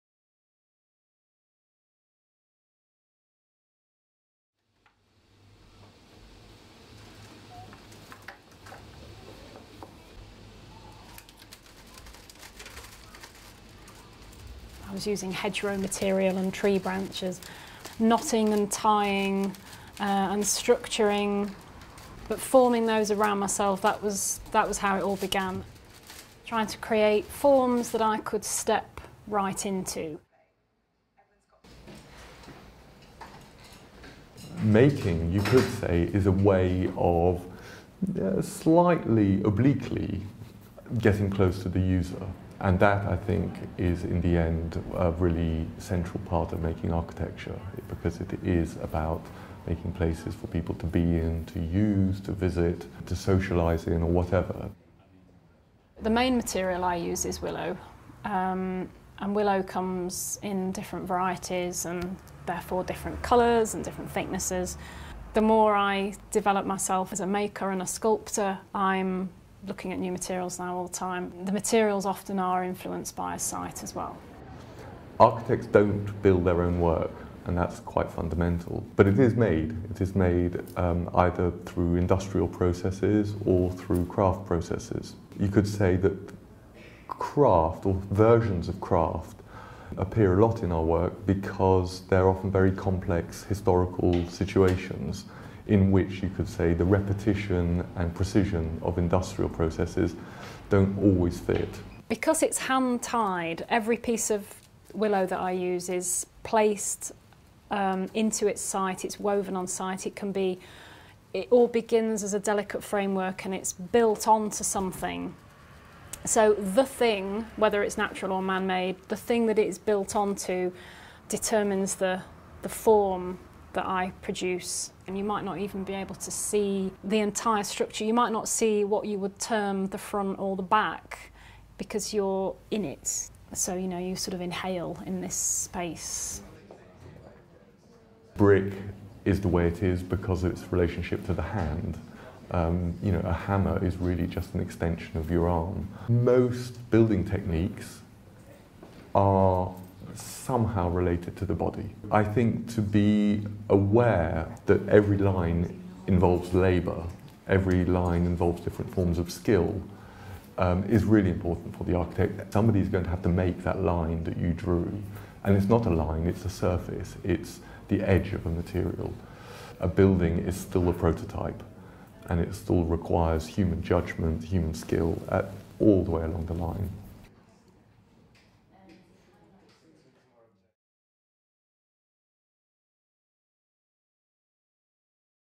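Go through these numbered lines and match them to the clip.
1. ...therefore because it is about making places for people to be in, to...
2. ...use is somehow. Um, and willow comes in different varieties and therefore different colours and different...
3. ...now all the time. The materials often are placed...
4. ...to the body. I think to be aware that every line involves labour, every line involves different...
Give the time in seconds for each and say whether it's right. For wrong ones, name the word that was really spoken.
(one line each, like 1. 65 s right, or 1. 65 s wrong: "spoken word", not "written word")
1. 46 s wrong: "architecture", not "therefore"
2. 56 s wrong: "willow", not "somehow"
3. 70 s wrong: "influenced", not "placed"
4. 151 s right.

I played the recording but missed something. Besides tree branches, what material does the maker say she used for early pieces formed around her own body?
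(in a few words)
hedgerow material.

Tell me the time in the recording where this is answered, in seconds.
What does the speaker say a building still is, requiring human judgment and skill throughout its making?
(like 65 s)
170 s.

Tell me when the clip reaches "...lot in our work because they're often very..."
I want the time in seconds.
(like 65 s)
90 s.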